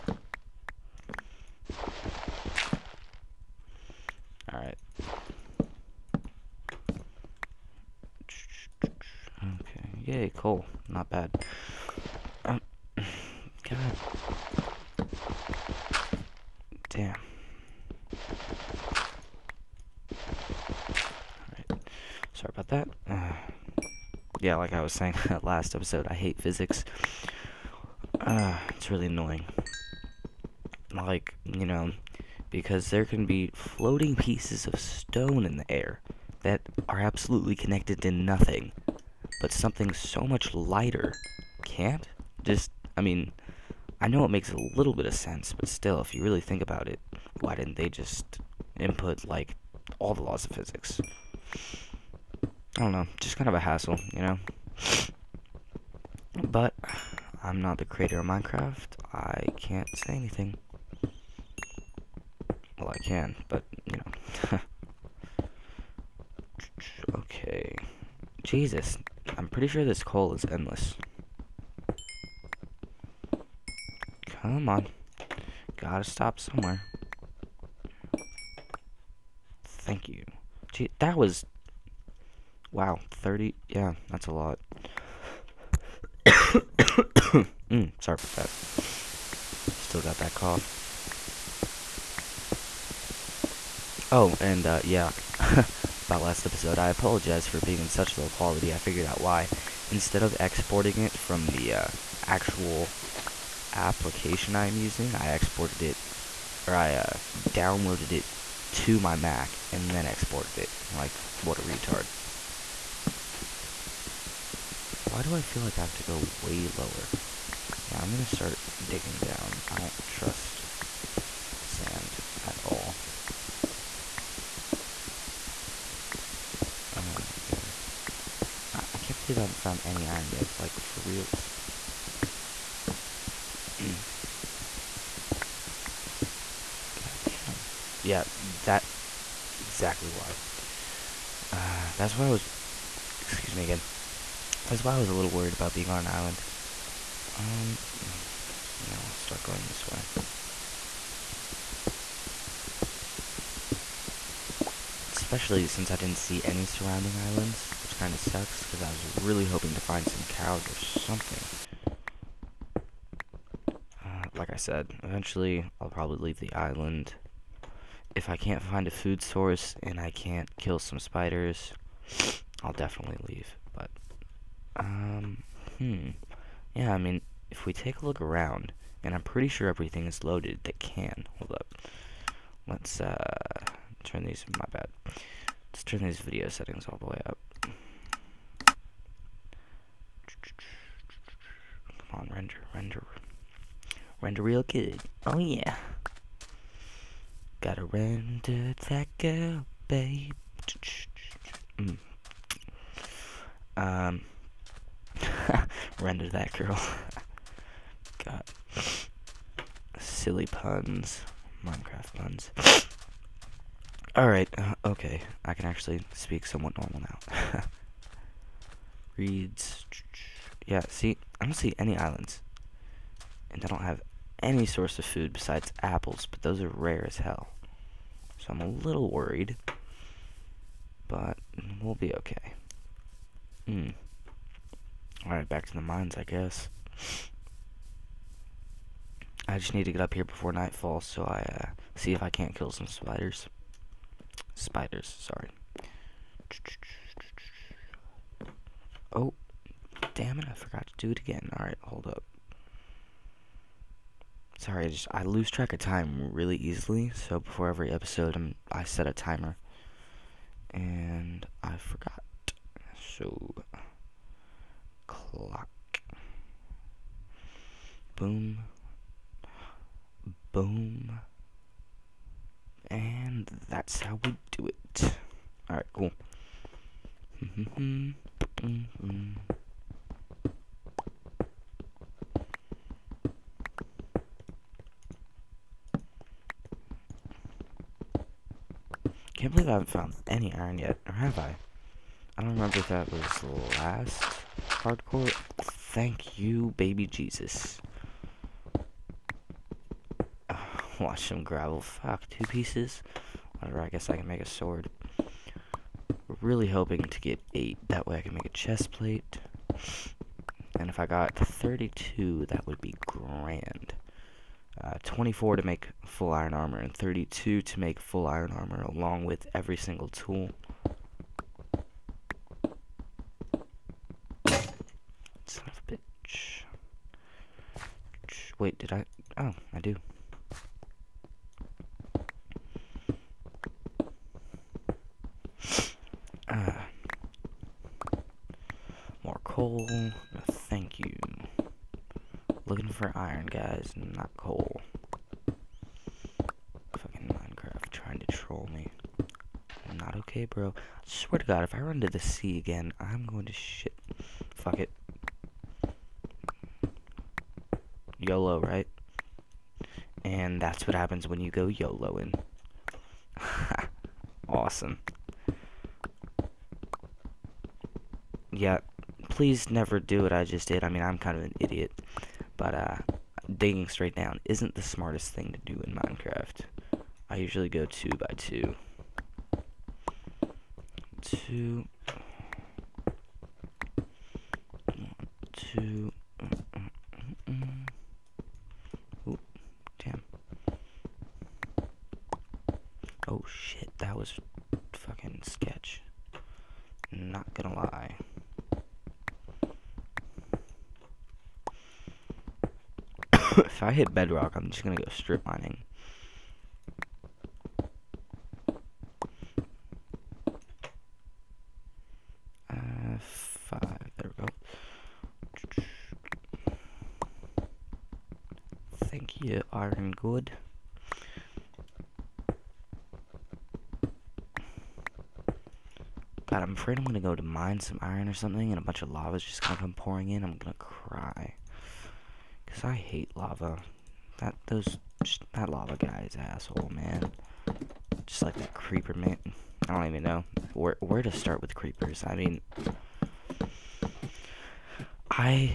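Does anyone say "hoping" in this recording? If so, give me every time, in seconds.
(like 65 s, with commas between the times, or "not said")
159 s, 306 s.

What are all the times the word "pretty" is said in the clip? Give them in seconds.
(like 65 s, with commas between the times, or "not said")
69 s, 179 s.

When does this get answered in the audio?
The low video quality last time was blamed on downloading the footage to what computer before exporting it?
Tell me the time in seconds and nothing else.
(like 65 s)
109 s.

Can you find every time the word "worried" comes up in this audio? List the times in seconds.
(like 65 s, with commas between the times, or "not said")
145 s, 229 s.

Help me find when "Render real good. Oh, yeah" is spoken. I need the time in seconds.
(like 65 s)
194 s.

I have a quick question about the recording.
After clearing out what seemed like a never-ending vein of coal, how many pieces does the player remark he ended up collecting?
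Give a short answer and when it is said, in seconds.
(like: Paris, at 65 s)
30, at 83 s.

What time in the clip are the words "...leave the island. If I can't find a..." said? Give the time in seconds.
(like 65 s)
166 s.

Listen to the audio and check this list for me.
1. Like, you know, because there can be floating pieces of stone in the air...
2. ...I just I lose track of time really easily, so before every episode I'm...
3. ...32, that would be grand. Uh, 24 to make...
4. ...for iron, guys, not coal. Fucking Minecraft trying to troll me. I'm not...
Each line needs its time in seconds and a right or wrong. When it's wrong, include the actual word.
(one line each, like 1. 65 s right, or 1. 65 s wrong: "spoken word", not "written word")
1. 30 s right
2. 254 s right
3. 311 s right
4. 342 s right.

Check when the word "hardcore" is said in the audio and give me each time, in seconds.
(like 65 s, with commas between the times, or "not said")
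294 s.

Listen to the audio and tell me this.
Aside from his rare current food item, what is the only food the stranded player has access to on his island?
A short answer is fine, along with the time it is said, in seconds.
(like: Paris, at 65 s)
apples, at 225 s.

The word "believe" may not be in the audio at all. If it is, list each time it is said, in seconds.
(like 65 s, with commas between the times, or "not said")
129 s, 289 s.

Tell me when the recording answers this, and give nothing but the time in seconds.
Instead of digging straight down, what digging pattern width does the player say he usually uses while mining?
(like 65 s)
377 s.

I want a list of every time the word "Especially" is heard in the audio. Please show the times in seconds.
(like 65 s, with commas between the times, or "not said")
155 s.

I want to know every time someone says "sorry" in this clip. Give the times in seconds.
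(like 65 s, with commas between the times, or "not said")
88 s, 245 s, 254 s.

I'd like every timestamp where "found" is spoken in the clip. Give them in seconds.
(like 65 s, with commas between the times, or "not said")
129 s, 289 s.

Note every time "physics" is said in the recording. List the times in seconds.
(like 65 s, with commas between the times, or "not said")
26 s, 50 s.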